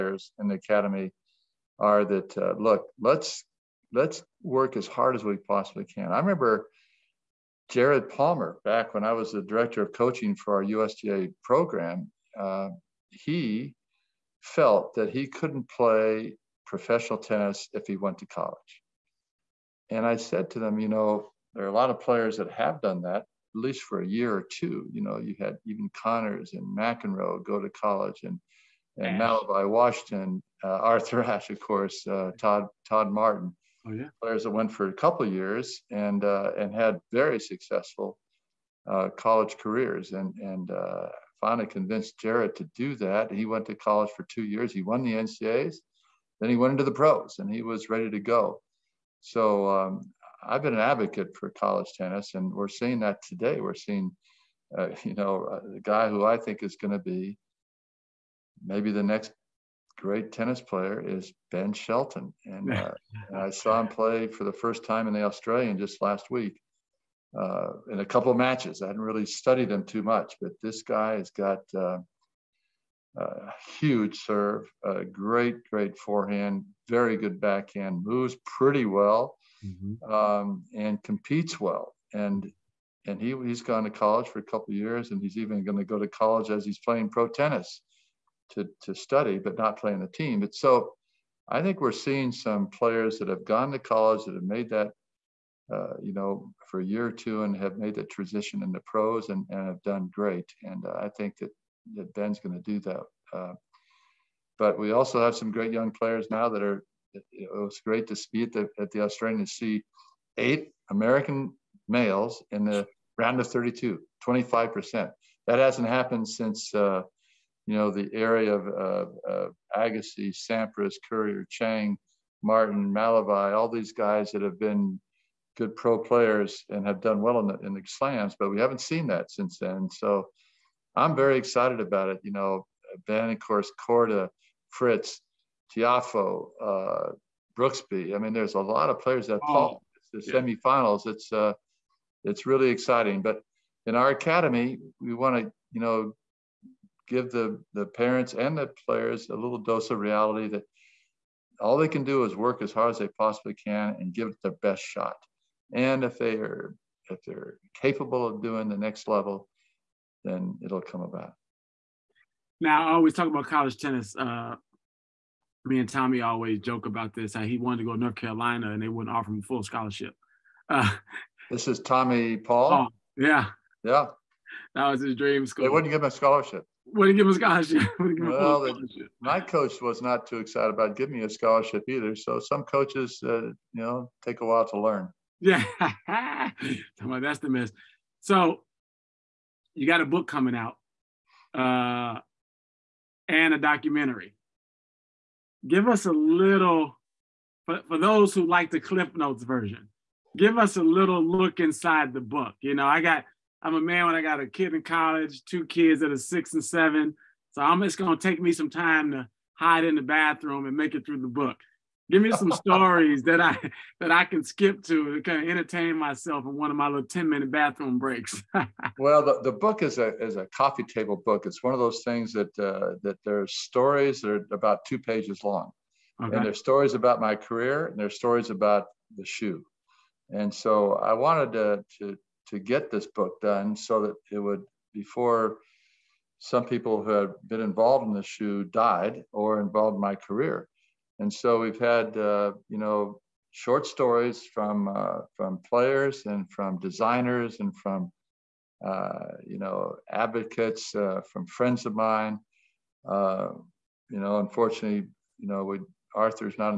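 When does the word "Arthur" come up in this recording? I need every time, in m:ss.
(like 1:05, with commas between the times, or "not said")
0:30, 4:16.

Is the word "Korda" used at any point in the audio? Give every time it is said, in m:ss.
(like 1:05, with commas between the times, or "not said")
2:13.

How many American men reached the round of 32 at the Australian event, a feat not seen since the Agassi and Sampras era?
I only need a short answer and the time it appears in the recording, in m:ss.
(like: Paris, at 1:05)
8, at 1:50.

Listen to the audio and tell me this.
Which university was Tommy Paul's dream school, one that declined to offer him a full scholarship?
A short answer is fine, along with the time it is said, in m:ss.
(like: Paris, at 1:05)
North Carolina, at 2:47.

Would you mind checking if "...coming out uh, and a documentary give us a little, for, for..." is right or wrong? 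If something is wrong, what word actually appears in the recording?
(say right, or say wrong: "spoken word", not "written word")
right.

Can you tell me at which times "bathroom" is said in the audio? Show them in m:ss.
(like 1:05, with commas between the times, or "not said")
3:30, 3:37.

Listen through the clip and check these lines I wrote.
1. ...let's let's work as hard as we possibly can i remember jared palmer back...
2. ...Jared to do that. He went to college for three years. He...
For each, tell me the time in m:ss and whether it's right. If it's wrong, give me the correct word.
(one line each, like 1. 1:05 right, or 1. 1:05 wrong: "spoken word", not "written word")
1. 0:03 right
2. 0:42 wrong: "two", not "three".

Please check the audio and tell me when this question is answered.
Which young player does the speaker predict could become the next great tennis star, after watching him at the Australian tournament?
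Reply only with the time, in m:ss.
1:01.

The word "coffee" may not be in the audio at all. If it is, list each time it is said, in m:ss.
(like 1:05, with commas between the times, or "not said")
3:40.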